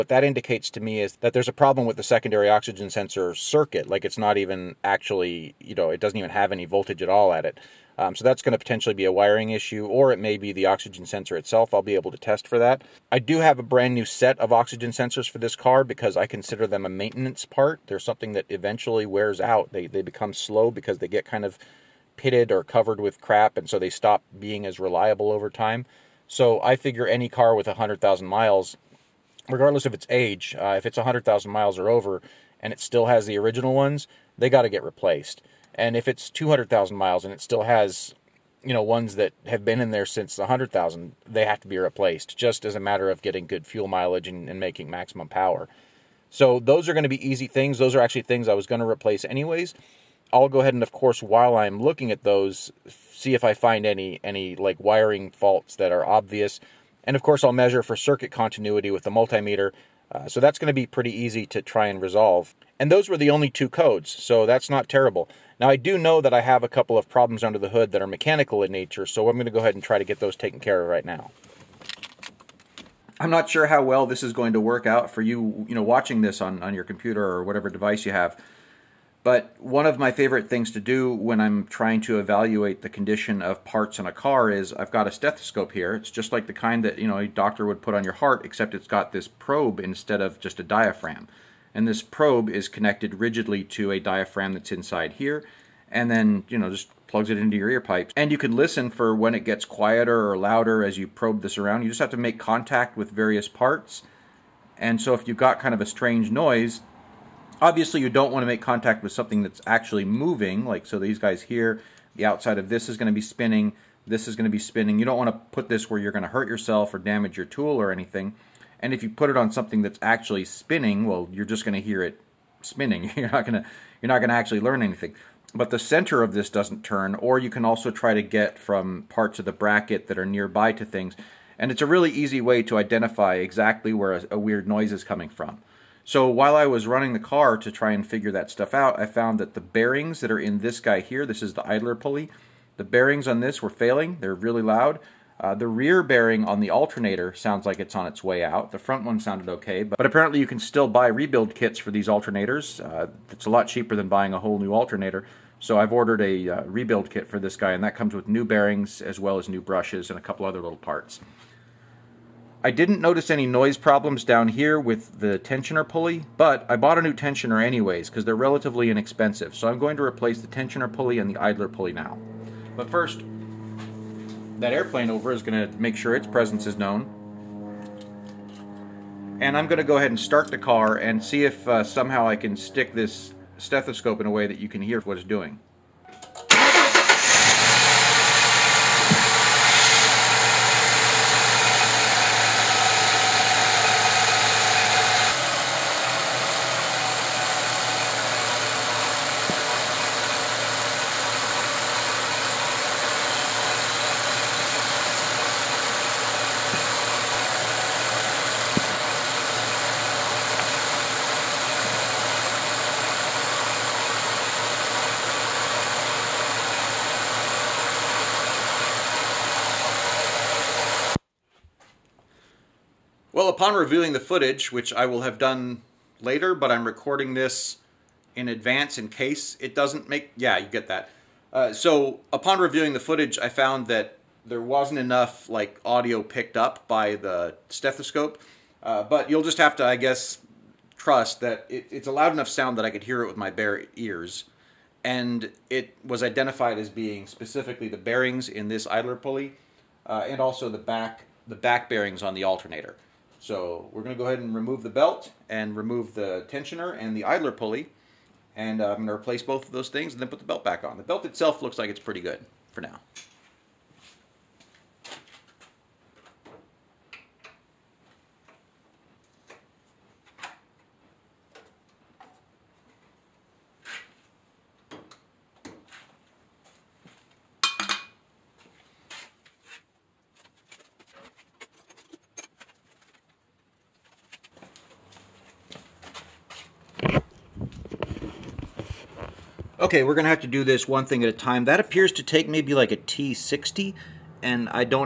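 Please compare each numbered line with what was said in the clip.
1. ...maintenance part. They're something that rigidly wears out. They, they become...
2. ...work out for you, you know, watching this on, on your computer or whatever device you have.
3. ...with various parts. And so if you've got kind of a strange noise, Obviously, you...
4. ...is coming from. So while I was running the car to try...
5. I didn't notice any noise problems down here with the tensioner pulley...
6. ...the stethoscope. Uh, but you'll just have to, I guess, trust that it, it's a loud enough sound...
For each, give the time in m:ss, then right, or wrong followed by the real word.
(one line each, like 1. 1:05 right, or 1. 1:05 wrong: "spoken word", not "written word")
1. 0:16 wrong: "eventually", not "rigidly"
2. 1:14 right
3. 1:42 right
4. 2:14 right
5. 2:42 right
6. 3:57 right.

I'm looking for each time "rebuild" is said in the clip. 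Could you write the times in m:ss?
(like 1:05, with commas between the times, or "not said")
2:31, 2:36.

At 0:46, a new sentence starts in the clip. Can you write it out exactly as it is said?
So those are going to be easy things.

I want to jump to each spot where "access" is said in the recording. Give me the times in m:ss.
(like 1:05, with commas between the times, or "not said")
not said.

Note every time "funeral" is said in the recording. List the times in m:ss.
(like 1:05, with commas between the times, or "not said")
not said.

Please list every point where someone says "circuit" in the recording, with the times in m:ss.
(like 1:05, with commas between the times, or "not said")
0:03, 0:57.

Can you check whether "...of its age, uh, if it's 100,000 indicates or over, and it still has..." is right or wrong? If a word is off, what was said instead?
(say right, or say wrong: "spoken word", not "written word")
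wrong: "miles", not "indicates".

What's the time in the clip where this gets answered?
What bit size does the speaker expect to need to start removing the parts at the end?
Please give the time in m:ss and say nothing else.
4:52.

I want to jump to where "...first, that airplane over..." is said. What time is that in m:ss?
2:52.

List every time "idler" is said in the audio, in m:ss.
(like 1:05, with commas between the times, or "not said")
2:21, 2:51, 4:08, 4:17.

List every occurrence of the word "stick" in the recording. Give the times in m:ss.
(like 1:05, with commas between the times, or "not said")
3:02.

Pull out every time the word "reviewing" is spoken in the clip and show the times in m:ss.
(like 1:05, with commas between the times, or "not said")
3:43, 3:52.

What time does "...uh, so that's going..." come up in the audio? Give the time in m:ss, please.
1:00.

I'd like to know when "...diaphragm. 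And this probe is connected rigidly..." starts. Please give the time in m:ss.
1:30.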